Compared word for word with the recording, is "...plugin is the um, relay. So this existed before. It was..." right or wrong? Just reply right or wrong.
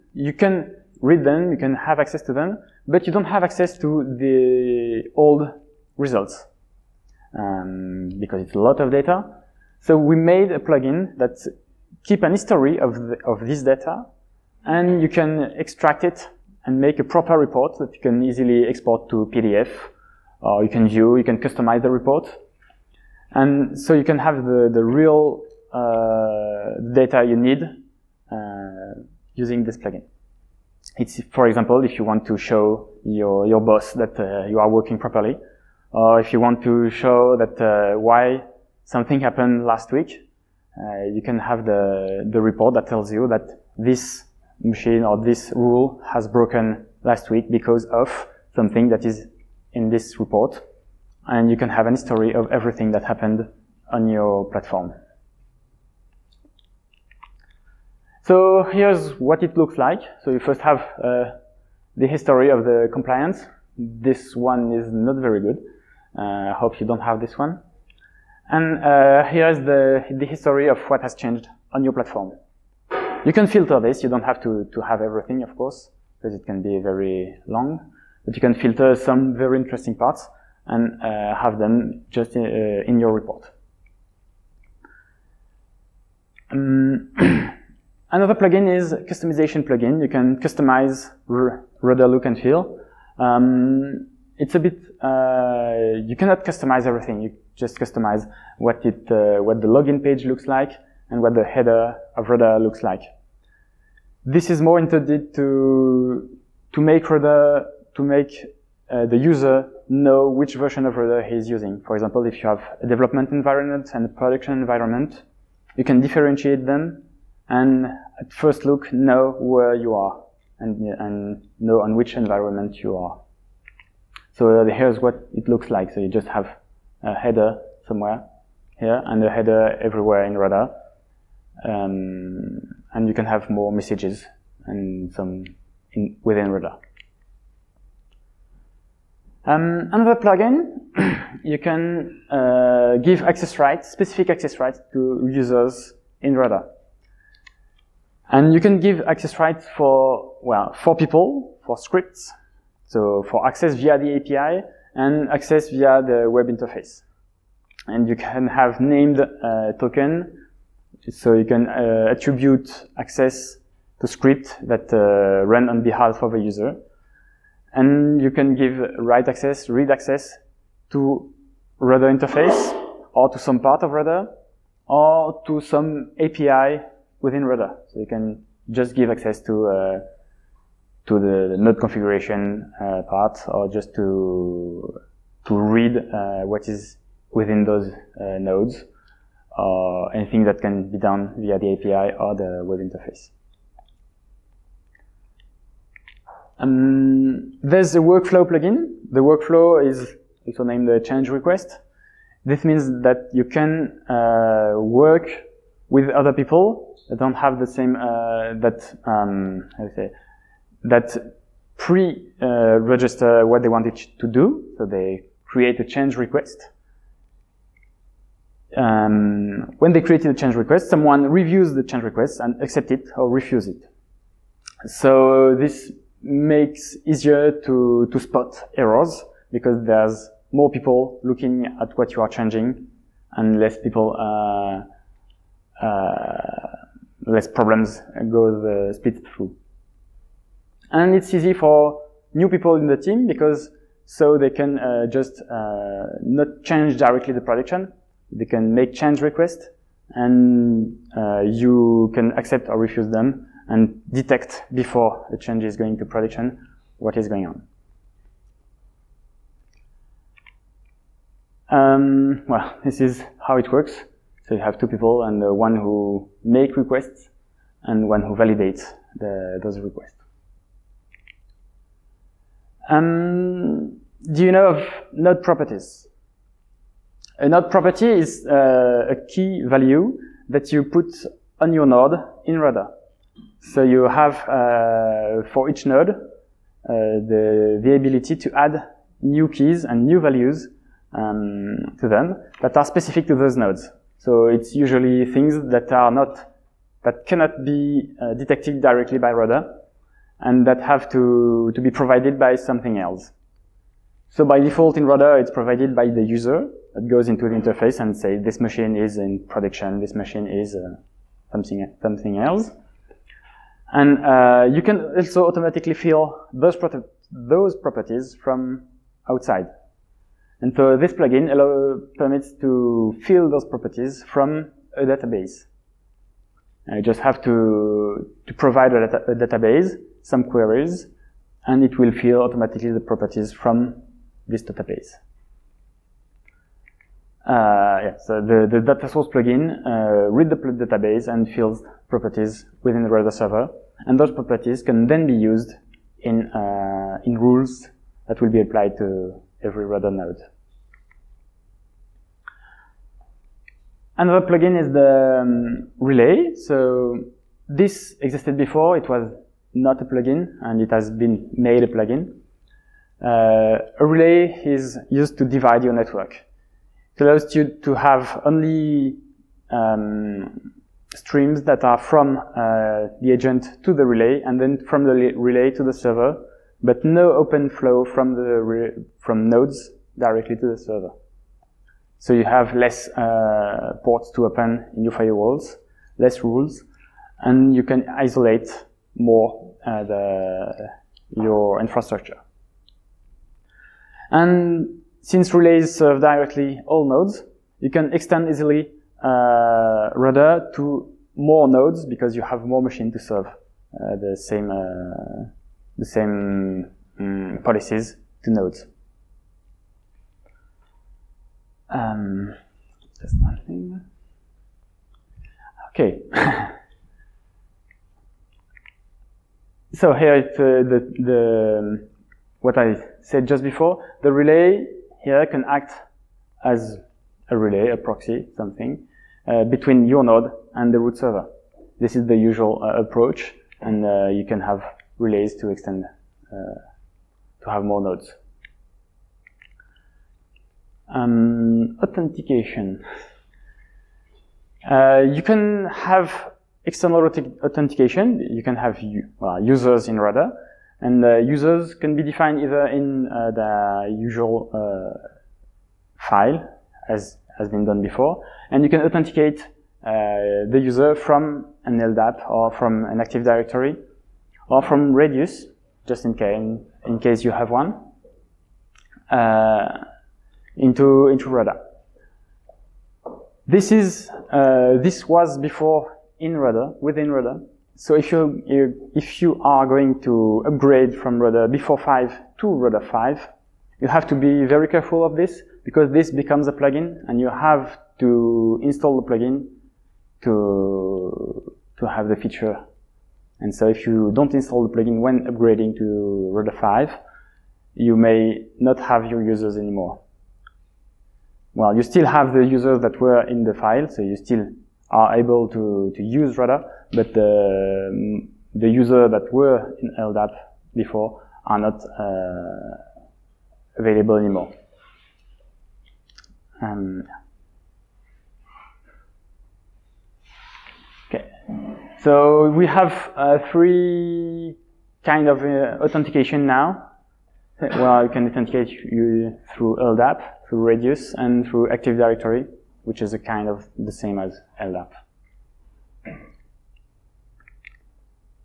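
right.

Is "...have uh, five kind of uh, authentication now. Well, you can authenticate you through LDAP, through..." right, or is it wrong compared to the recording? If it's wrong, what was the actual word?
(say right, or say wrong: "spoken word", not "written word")
wrong: "three", not "five".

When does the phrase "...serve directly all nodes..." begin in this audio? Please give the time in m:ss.
6:35.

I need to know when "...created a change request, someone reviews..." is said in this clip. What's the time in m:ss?
3:40.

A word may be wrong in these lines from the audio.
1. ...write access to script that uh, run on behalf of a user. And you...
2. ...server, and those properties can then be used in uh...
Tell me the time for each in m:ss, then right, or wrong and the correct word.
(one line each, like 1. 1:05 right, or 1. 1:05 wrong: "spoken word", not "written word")
1. 2:42 wrong: "attribute", not "write"
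2. 5:43 right.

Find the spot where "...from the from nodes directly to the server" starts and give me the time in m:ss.
6:18.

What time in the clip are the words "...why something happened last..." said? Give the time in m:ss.
0:37.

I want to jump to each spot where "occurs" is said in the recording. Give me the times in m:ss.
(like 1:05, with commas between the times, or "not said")
not said.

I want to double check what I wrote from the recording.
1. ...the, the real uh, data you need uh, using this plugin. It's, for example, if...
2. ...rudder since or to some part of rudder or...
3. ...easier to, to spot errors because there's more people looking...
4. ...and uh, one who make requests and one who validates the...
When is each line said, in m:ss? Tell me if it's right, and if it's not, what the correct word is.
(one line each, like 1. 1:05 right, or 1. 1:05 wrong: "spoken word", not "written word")
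1. 0:24 right
2. 2:51 wrong: "interface", not "since"
3. 3:47 right
4. 4:25 right.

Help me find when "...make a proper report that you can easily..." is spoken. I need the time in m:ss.
0:16.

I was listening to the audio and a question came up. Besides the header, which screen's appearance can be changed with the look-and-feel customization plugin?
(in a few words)
the login page.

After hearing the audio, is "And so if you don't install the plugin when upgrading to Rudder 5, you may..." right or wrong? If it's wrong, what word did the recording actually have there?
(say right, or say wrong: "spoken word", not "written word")
right.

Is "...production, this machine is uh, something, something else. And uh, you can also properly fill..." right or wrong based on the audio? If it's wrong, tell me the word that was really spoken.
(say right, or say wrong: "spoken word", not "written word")
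wrong: "automatically", not "properly".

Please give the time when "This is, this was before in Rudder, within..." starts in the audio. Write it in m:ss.
7:53.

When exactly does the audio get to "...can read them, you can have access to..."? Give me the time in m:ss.
0:00.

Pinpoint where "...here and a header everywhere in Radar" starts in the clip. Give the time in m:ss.
2:08.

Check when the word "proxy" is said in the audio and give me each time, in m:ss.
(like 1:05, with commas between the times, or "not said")
7:07.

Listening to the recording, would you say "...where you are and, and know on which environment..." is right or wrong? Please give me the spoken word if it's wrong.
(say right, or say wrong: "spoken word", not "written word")
right.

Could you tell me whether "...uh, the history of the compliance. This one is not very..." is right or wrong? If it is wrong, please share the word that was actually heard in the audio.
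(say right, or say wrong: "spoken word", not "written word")
right.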